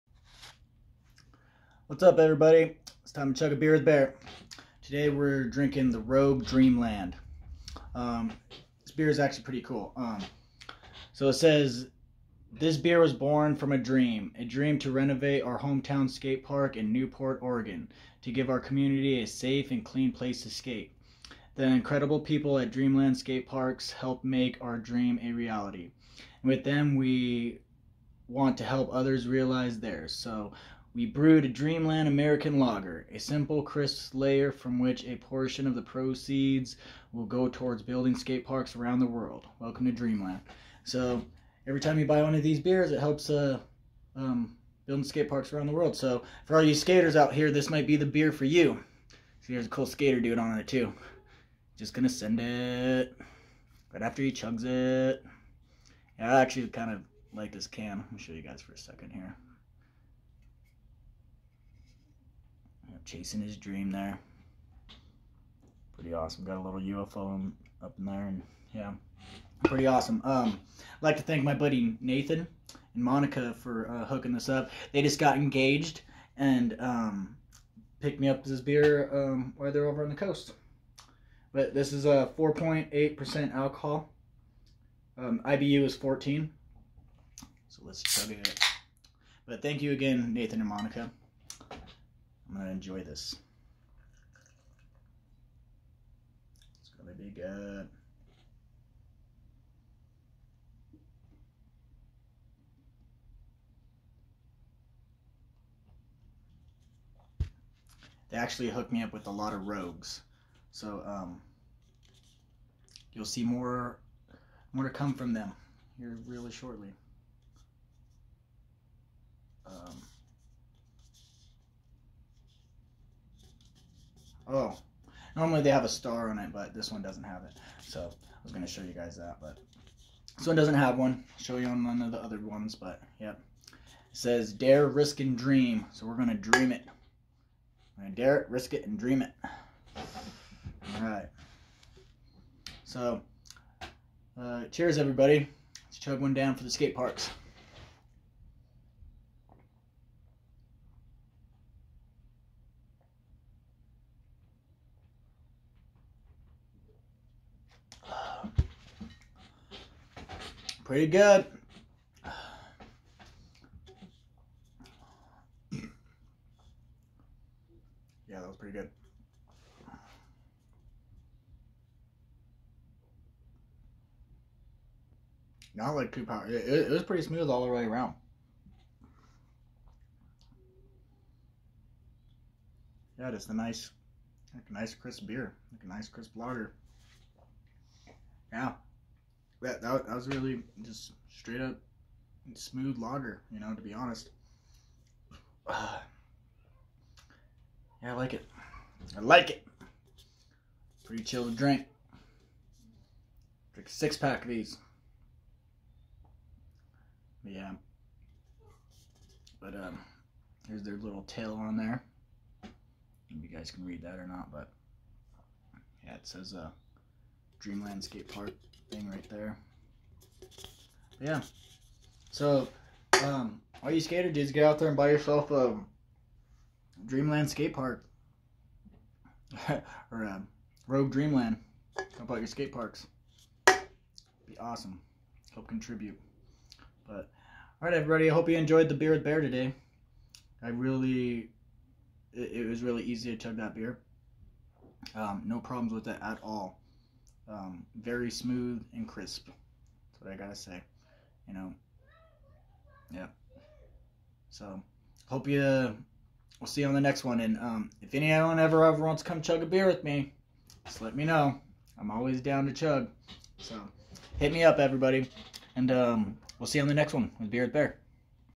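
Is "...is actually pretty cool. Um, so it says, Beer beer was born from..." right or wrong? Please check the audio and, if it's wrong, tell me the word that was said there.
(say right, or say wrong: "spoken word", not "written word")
wrong: "This", not "Beer".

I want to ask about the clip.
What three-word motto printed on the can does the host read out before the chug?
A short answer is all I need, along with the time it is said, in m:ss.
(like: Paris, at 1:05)
Dare, risk, and dream, at 2:14.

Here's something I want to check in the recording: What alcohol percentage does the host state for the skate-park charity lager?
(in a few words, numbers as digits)
4.8%.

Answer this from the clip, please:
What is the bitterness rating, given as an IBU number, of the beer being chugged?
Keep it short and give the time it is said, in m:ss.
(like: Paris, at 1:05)
14, at 1:25.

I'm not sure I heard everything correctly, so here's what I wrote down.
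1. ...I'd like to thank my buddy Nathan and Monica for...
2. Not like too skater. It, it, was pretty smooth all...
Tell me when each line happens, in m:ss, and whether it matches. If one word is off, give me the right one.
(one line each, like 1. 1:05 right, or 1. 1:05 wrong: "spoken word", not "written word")
1. 1:10 right
2. 2:55 wrong: "power", not "skater".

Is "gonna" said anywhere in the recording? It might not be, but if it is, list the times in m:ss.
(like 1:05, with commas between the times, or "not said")
0:51, 1:32, 1:36.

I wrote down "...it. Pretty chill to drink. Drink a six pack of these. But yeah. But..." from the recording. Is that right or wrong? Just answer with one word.
right.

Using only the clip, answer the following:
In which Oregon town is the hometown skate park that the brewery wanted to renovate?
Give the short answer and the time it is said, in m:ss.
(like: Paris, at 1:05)
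Newport, at 0:16.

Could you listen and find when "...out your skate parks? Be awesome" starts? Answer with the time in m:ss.
3:52.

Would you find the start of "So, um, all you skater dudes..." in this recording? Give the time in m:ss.
3:42.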